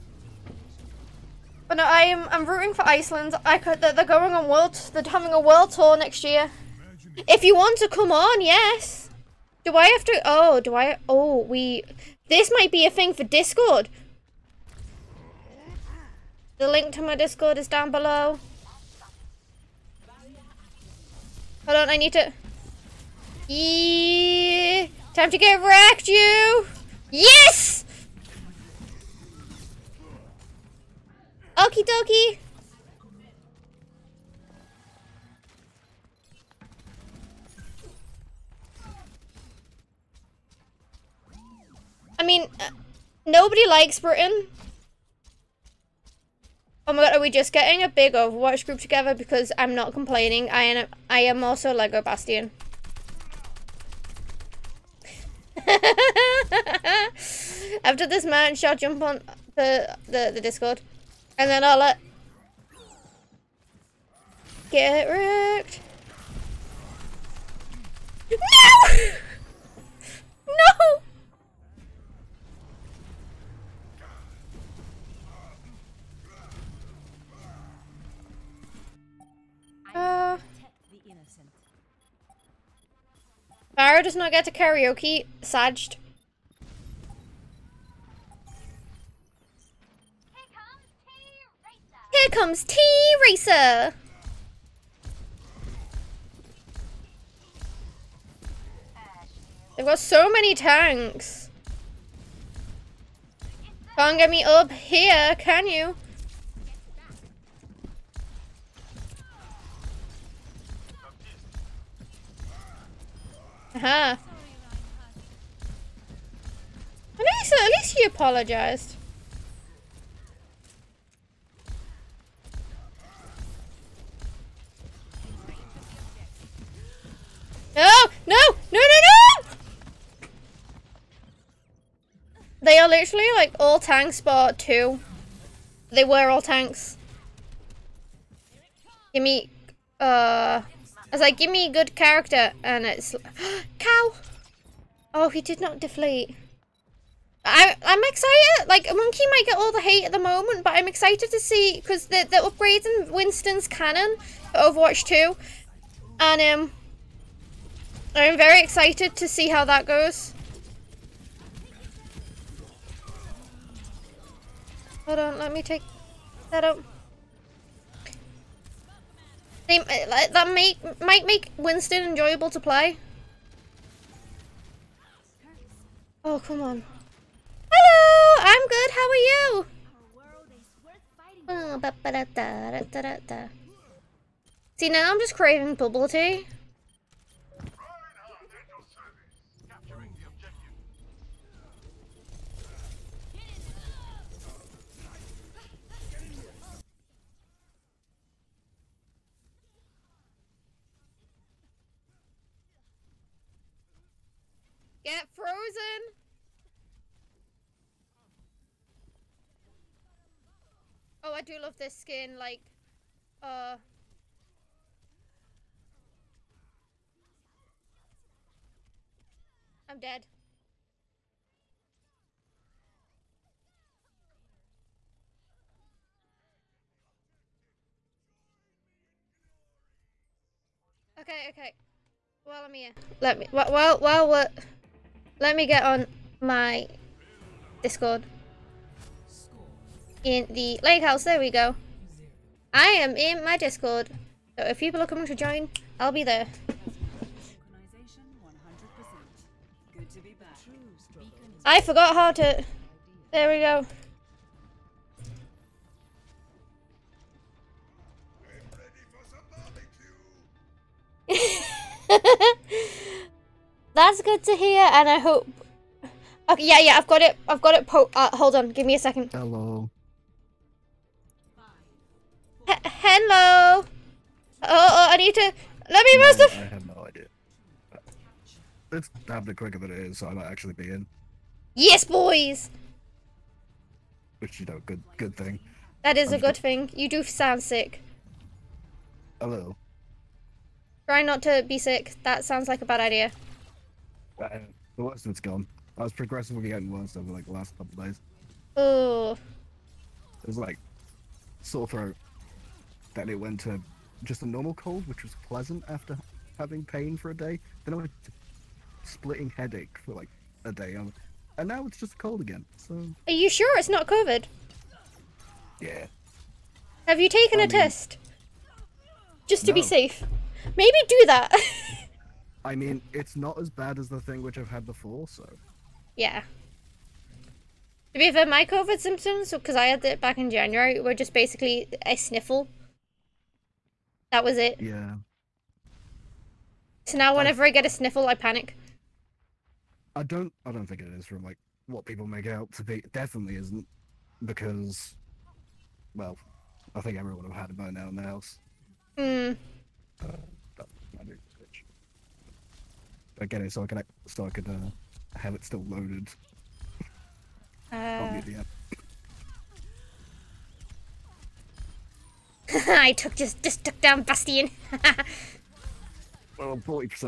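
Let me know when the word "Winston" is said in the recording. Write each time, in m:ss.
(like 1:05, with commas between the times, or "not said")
2:33, 2:51.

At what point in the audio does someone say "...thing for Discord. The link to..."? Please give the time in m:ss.
0:12.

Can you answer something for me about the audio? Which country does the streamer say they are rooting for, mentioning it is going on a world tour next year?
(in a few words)
Iceland.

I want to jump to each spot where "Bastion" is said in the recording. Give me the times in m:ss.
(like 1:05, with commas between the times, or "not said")
0:52, 6:04.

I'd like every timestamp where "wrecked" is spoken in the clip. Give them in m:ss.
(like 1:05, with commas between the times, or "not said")
0:25, 1:05.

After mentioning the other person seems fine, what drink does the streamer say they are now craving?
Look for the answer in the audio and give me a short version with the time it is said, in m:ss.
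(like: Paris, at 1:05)
Bubble tea, at 3:05.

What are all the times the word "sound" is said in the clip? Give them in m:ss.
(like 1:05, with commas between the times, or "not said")
4:47, 4:52.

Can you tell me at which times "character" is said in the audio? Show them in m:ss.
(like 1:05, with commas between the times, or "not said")
2:21.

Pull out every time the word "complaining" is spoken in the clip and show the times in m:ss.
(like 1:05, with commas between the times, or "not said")
0:49.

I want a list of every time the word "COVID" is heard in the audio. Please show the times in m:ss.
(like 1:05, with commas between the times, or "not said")
5:14, 5:28.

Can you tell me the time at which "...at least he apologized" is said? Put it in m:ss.
1:57.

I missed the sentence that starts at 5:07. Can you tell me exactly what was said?
Then I went to splitting headache for like a day.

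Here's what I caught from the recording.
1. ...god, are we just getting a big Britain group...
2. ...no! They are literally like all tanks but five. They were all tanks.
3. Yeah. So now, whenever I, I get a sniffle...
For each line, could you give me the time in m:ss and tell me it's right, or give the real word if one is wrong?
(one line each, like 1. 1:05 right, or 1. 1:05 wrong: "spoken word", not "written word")
1. 0:47 wrong: "Overwatch", not "Britain"
2. 2:08 wrong: "two", not "five"
3. 5:34 right.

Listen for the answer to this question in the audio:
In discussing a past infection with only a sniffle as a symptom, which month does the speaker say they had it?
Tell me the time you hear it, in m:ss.
5:30.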